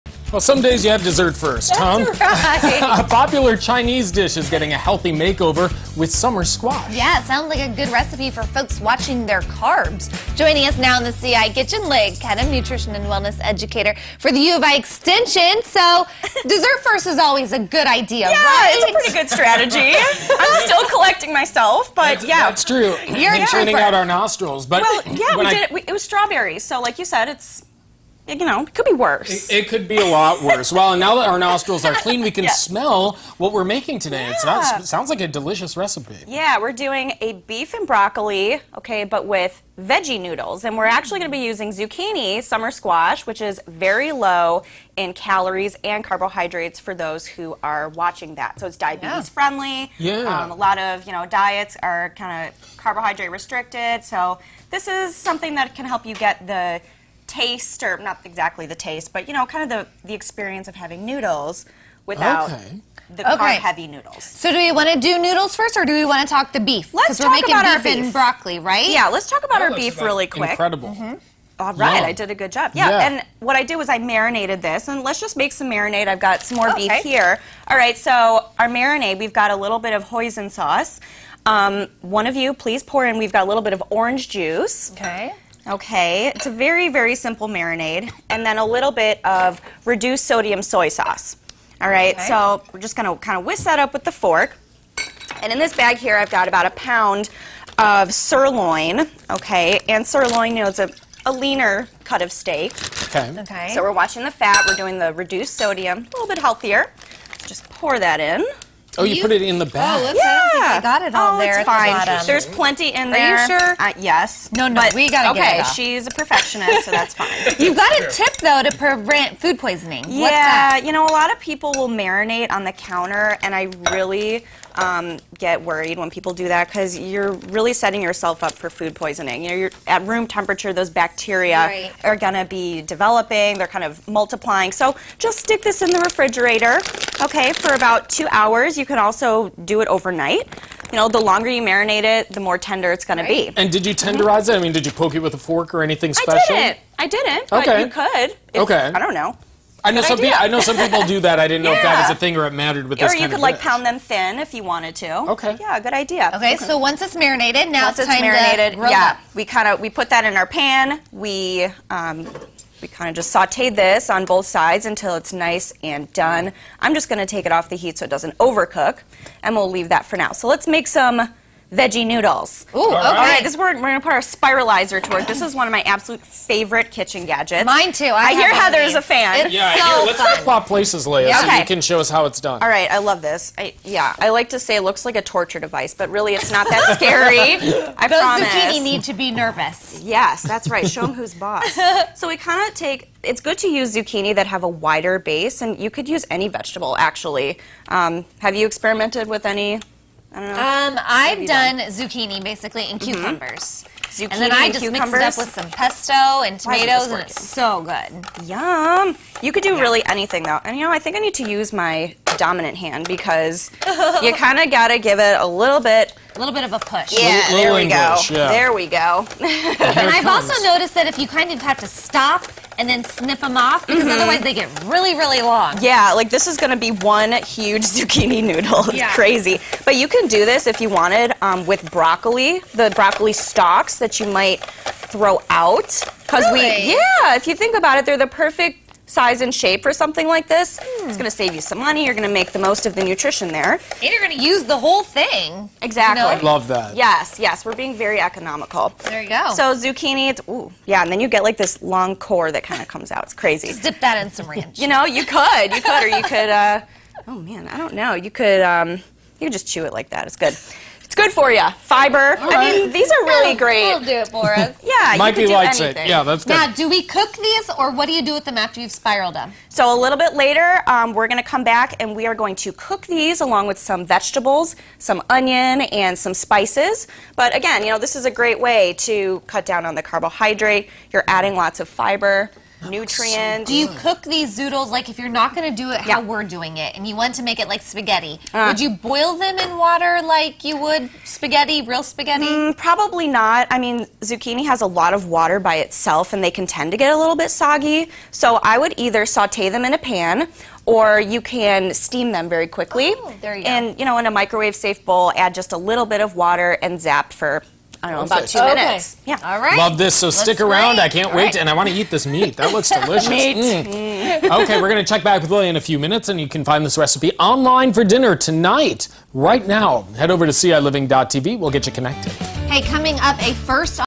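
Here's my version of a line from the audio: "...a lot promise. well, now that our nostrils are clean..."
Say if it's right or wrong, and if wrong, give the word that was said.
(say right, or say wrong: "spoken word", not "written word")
wrong: "worse", not "promise".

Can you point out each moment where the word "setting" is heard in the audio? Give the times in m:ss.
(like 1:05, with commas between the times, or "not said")
2:07.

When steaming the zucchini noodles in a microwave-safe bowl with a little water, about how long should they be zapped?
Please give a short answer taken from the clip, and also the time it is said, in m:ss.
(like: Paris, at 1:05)
2 minutes, at 5:08.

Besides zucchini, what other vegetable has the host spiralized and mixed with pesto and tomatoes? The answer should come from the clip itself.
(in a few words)
cucumbers.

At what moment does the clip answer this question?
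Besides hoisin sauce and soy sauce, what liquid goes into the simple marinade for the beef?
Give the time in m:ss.
1:23.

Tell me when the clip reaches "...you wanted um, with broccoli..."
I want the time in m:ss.
3:50.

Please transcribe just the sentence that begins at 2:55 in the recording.
This is one of my absolute favorite kitchen gadgets.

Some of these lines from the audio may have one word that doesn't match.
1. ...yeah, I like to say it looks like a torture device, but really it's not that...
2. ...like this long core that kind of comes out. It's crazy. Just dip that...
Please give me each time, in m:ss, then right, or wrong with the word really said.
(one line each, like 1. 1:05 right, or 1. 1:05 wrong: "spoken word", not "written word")
1. 3:03 right
2. 4:11 right.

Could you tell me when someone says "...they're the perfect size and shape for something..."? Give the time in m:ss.
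3:58.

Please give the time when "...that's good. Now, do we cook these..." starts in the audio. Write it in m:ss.
4:26.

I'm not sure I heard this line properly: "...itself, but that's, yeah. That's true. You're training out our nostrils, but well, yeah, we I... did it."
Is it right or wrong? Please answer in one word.
wrong.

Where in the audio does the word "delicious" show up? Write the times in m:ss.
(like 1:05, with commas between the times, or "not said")
0:35, 5:12.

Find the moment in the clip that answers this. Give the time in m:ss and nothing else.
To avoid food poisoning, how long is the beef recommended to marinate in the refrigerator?
2:18.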